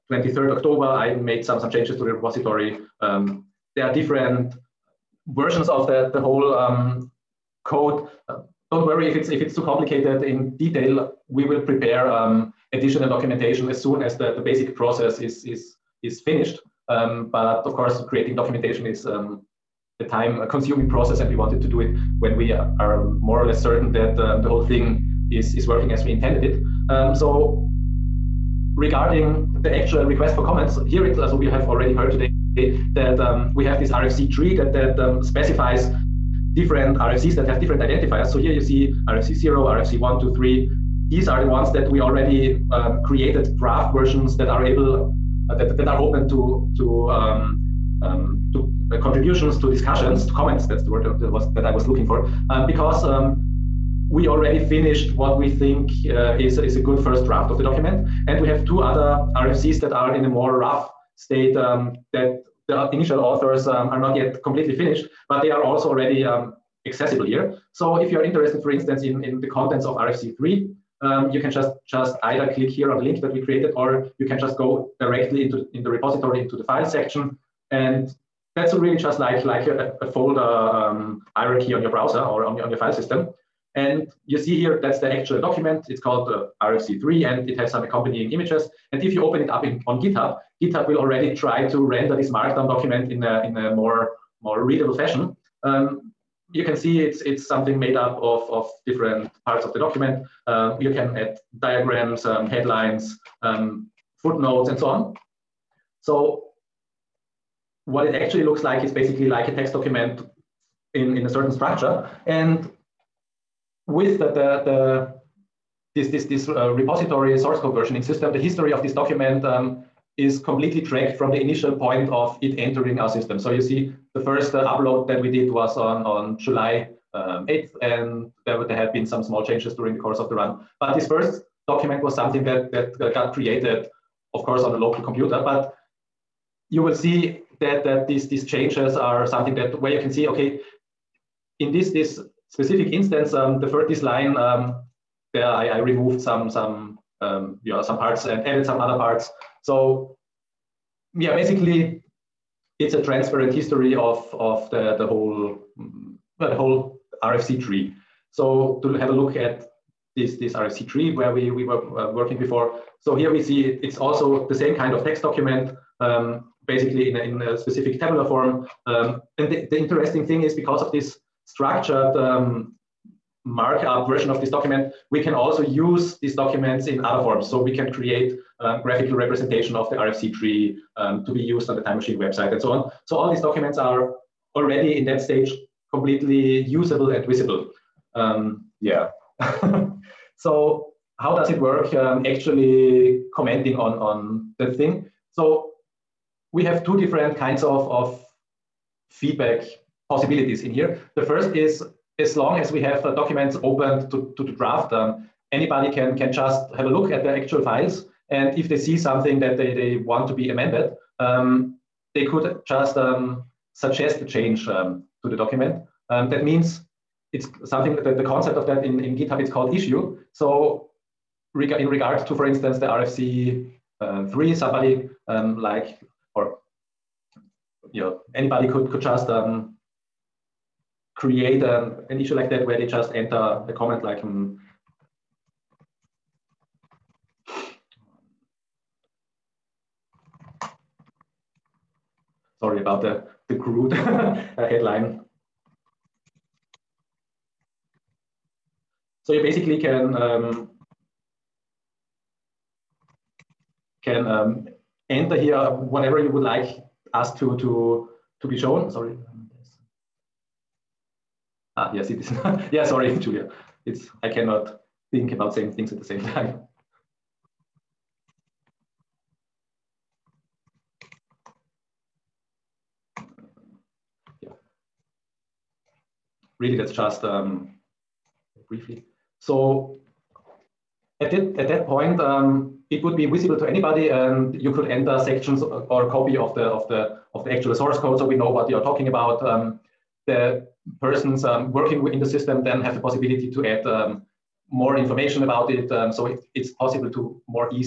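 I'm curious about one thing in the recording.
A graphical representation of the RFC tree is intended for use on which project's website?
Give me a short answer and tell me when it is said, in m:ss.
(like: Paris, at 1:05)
Time Machine, at 3:01.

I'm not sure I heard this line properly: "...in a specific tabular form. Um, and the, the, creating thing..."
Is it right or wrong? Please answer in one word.
wrong.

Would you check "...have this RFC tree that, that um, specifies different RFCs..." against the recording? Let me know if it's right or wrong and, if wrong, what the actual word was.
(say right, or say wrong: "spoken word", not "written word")
right.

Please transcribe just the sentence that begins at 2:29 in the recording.
So yeah, basically it's a transparent history of, of the, the whole well, the whole RFC tree.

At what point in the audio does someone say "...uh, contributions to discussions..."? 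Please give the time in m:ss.
0:48.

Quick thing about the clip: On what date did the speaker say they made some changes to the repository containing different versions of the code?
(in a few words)
23rd October.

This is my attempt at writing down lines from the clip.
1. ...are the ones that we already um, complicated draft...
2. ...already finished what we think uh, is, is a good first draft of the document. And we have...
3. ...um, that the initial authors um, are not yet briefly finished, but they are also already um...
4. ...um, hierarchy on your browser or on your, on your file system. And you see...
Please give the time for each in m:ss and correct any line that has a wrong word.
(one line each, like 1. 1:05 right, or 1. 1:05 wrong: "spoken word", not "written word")
1. 0:41 wrong: "created", not "complicated"
2. 0:54 right
3. 1:01 wrong: "completely", not "briefly"
4. 1:20 right.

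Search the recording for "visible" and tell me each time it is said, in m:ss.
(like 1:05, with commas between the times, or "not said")
3:07, 4:43.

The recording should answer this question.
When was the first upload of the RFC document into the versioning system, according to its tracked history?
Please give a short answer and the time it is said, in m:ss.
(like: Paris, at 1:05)
July 8th, at 2:06.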